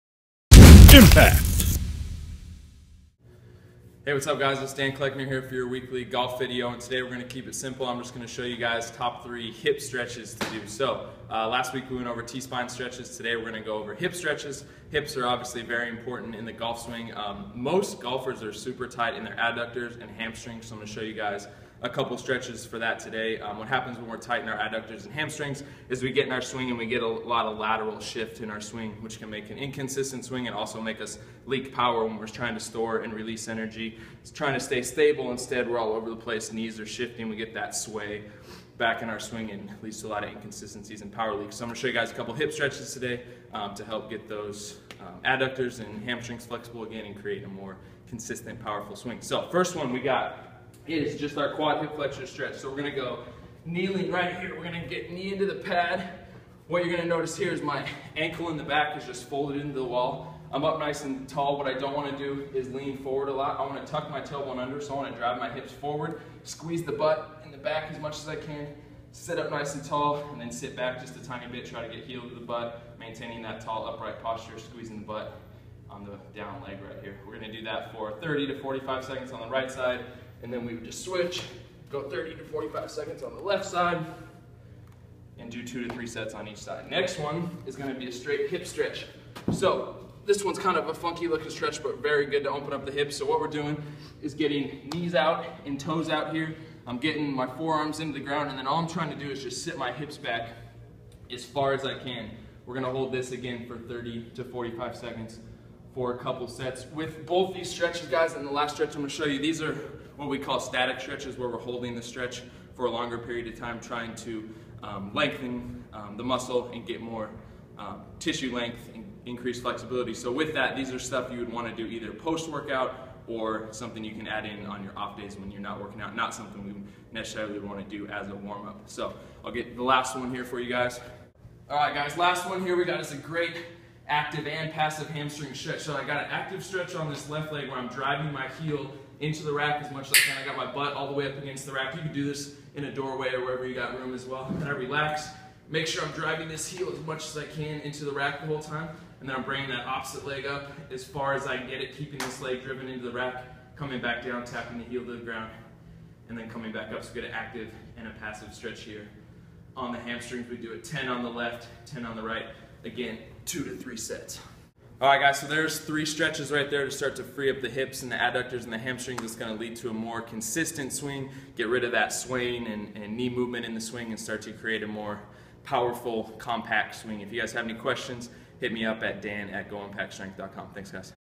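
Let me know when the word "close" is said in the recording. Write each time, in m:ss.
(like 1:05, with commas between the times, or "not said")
not said.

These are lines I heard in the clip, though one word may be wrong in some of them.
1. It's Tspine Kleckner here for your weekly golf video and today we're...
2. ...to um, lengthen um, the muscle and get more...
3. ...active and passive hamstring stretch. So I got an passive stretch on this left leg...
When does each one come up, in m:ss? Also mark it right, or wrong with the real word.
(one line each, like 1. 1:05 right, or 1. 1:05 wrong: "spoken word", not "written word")
1. 0:04 wrong: "Dan", not "Tspine"
2. 1:54 right
3. 2:14 wrong: "active", not "passive".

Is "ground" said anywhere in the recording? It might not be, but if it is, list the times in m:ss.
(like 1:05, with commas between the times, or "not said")
1:38, 2:35.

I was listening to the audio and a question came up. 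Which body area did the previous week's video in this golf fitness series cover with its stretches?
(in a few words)
T-spine.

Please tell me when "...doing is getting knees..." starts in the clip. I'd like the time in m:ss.
1:33.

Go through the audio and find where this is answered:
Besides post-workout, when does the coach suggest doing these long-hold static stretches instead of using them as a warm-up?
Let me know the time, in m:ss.
2:04.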